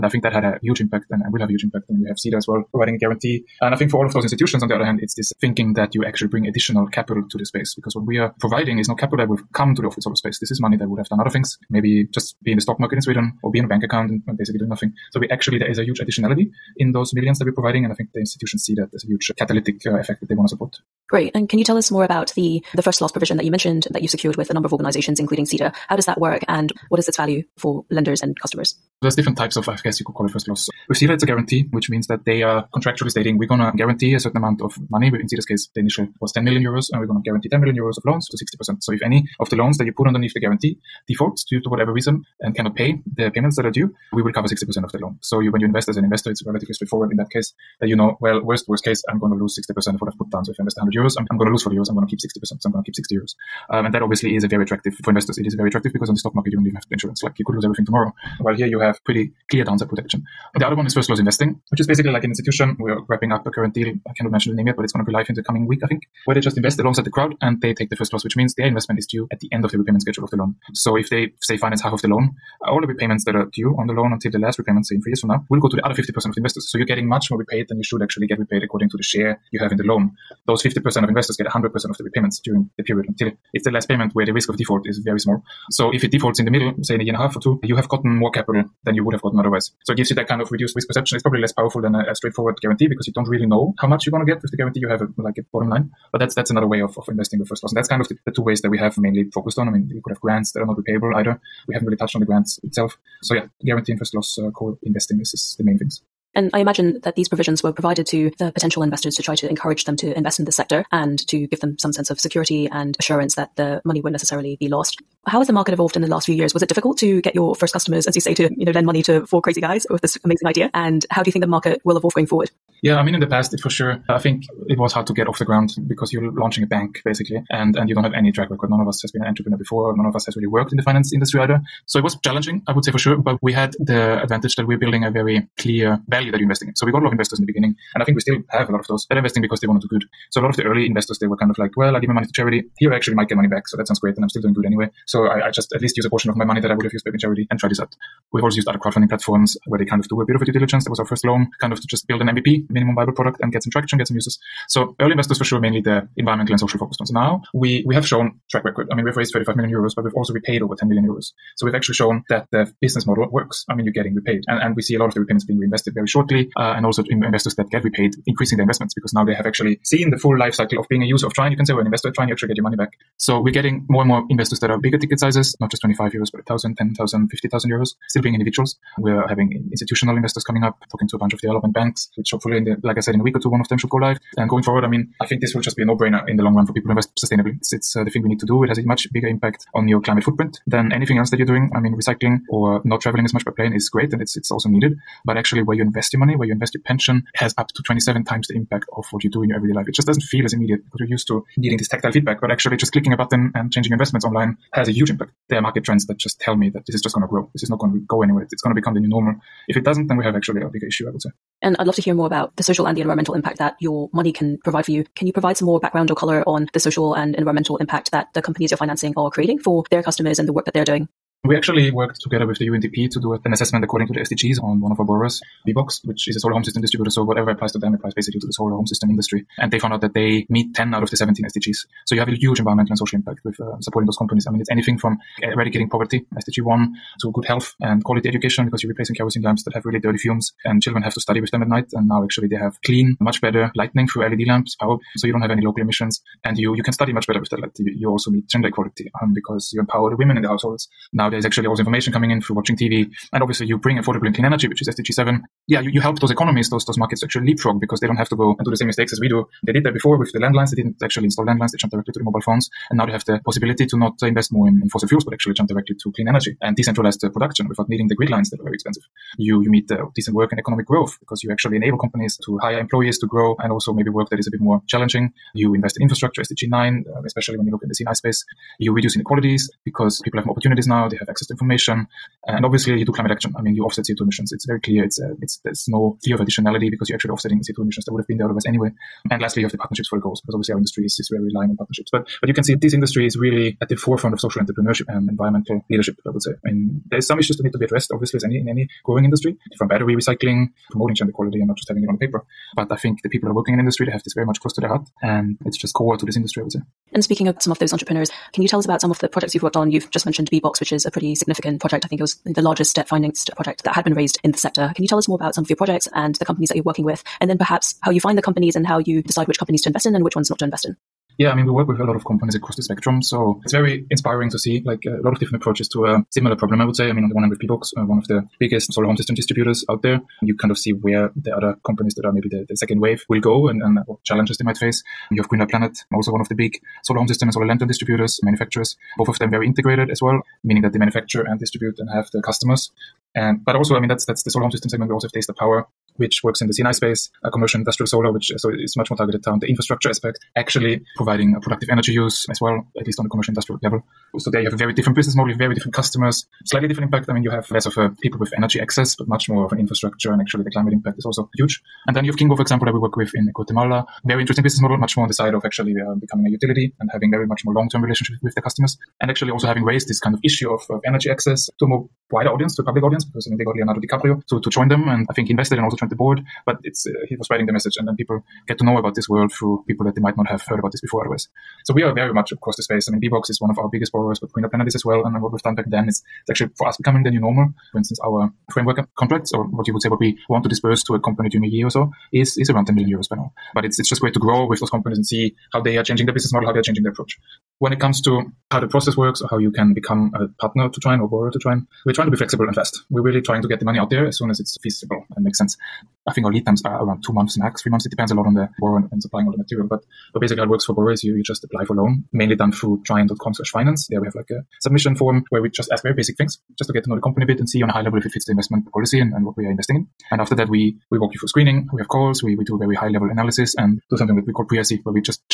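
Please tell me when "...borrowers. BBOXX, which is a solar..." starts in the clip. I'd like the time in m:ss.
3:45.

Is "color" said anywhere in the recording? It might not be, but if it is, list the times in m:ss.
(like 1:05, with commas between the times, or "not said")
3:36.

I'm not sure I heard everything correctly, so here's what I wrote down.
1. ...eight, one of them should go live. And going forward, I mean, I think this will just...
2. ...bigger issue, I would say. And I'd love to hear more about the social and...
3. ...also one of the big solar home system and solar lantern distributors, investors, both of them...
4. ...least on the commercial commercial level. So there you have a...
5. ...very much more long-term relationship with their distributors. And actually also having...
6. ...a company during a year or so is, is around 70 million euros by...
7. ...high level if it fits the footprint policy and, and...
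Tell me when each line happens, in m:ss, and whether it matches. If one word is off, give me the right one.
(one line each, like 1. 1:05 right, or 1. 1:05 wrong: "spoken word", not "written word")
1. 3:03 wrong: "two", not "eight"
2. 3:30 right
3. 5:36 wrong: "manufacturers", not "investors"
4. 5:53 wrong: "industrial", not "commercial"
5. 6:07 wrong: "customers", not "distributors"
6. 6:31 wrong: "10", not "70"
7. 6:57 wrong: "investment", not "footprint".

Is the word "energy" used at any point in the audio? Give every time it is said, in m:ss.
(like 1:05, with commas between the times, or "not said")
4:14, 4:26, 5:51, 5:58, 6:11.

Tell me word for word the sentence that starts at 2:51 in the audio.
You can say, or an investor at you actually get your money back.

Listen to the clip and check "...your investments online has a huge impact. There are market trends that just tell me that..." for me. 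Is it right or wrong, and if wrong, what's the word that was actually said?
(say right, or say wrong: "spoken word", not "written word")
right.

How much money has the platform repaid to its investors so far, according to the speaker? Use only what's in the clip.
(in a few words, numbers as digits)
over 10 million euros.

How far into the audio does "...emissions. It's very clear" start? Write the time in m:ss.
4:44.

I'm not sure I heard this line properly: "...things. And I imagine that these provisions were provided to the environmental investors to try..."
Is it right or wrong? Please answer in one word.
wrong.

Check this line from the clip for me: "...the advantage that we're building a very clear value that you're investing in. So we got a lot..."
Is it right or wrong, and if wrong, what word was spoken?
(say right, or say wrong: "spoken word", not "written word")
right.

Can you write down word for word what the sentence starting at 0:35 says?
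In Sida's case, the initial was 10 million euros, and we're gonna guarantee 10 million euros of loans to 60%.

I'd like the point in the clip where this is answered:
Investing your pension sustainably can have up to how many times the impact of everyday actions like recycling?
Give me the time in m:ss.
3:17.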